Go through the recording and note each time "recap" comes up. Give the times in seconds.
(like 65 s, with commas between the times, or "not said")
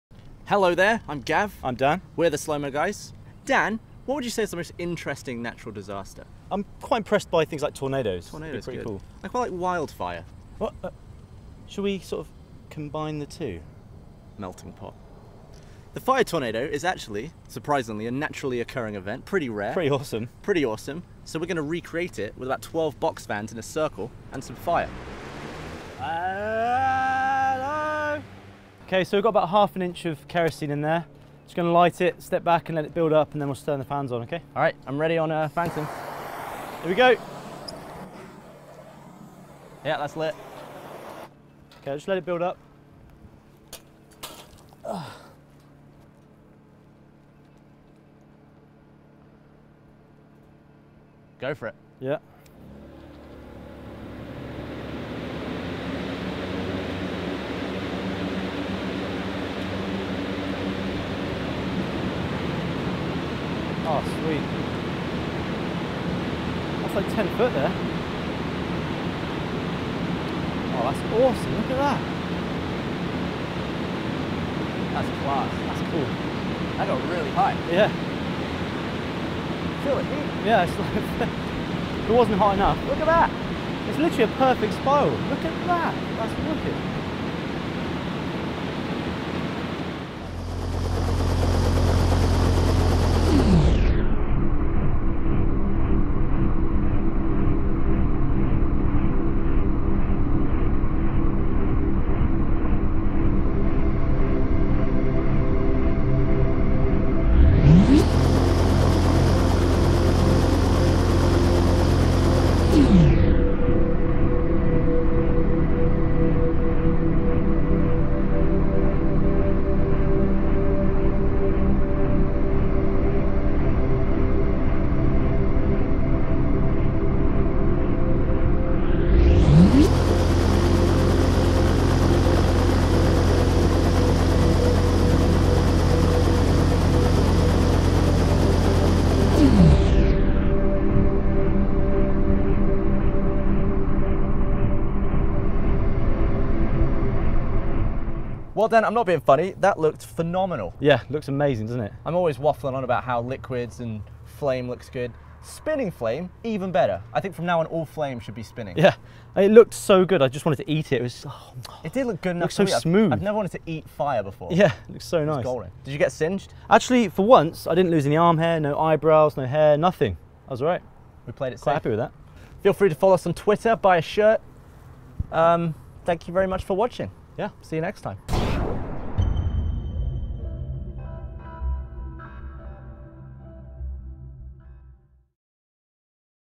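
not said.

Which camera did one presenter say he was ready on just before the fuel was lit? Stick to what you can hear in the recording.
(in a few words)
Phantom.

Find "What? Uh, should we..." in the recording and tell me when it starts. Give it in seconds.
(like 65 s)
10 s.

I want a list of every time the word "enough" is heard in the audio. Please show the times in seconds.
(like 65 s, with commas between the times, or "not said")
82 s, 162 s.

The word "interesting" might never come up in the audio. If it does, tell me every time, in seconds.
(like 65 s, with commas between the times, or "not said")
4 s.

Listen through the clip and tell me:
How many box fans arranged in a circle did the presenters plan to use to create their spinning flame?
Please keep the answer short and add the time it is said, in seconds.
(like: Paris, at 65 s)
12, at 22 s.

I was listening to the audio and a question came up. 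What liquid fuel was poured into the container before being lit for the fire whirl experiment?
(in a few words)
kerosene.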